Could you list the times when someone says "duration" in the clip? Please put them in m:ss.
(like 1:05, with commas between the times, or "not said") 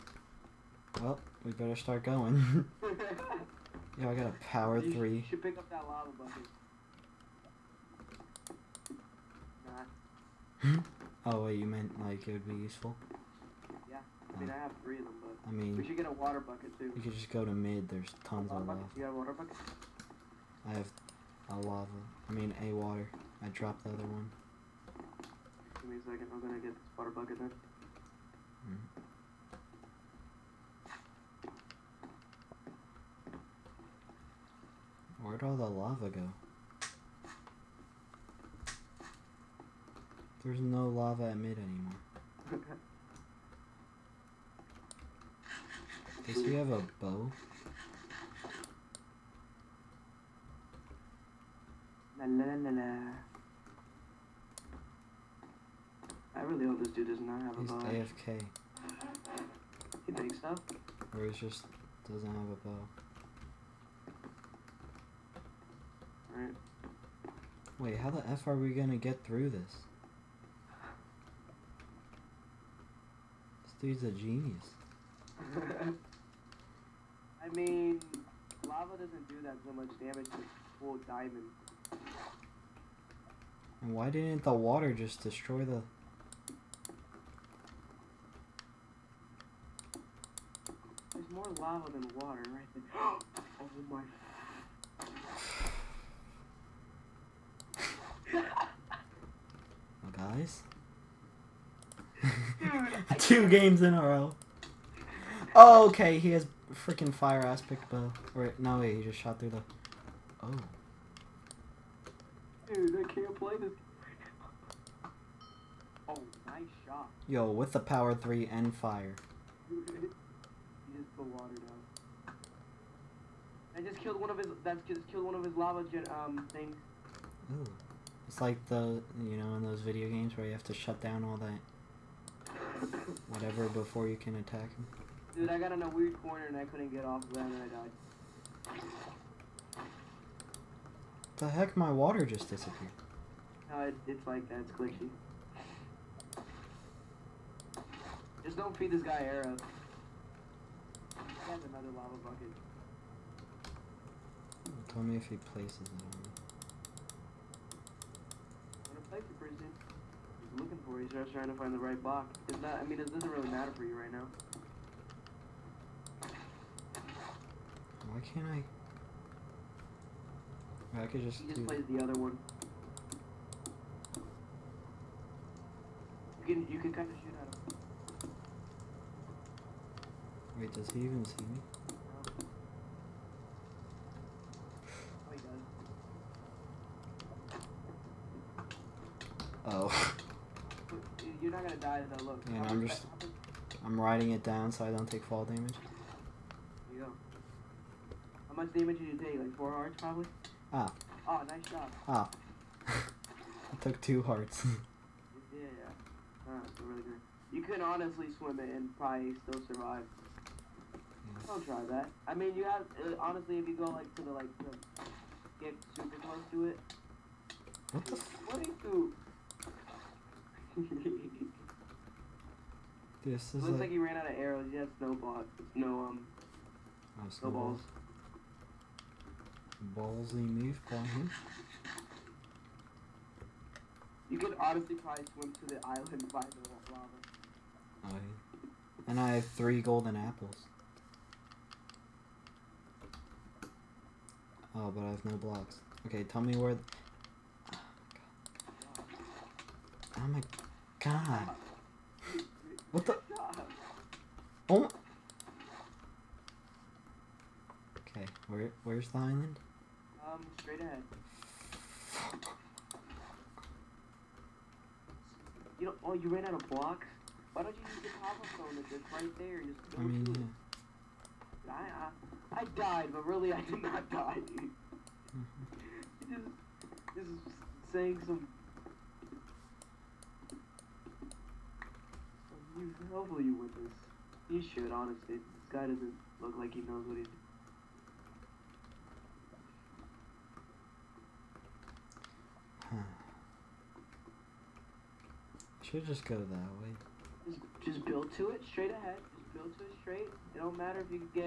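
not said.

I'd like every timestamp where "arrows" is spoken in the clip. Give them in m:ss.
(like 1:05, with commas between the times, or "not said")
2:29, 3:44.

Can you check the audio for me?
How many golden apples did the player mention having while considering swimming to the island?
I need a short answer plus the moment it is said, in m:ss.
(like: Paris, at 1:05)
3, at 3:59.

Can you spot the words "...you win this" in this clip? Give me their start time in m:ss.
4:43.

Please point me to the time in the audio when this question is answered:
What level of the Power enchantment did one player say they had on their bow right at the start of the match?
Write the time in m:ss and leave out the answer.
0:04.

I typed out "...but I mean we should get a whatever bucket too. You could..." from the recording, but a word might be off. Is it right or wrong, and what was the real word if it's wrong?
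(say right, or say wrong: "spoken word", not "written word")
wrong: "water", not "whatever".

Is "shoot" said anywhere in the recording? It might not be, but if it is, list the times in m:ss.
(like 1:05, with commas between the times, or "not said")
2:57.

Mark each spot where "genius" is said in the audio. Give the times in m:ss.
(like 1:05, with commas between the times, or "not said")
1:14.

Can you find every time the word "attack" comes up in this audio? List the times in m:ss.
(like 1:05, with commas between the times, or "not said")
2:14.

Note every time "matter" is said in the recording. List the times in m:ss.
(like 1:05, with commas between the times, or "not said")
2:43, 5:00.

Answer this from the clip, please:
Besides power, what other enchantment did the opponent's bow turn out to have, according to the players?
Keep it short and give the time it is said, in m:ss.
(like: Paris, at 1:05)
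fire aspect, at 1:47.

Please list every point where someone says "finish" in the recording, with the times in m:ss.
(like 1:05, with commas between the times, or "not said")
not said.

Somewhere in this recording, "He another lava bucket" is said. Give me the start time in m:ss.
2:31.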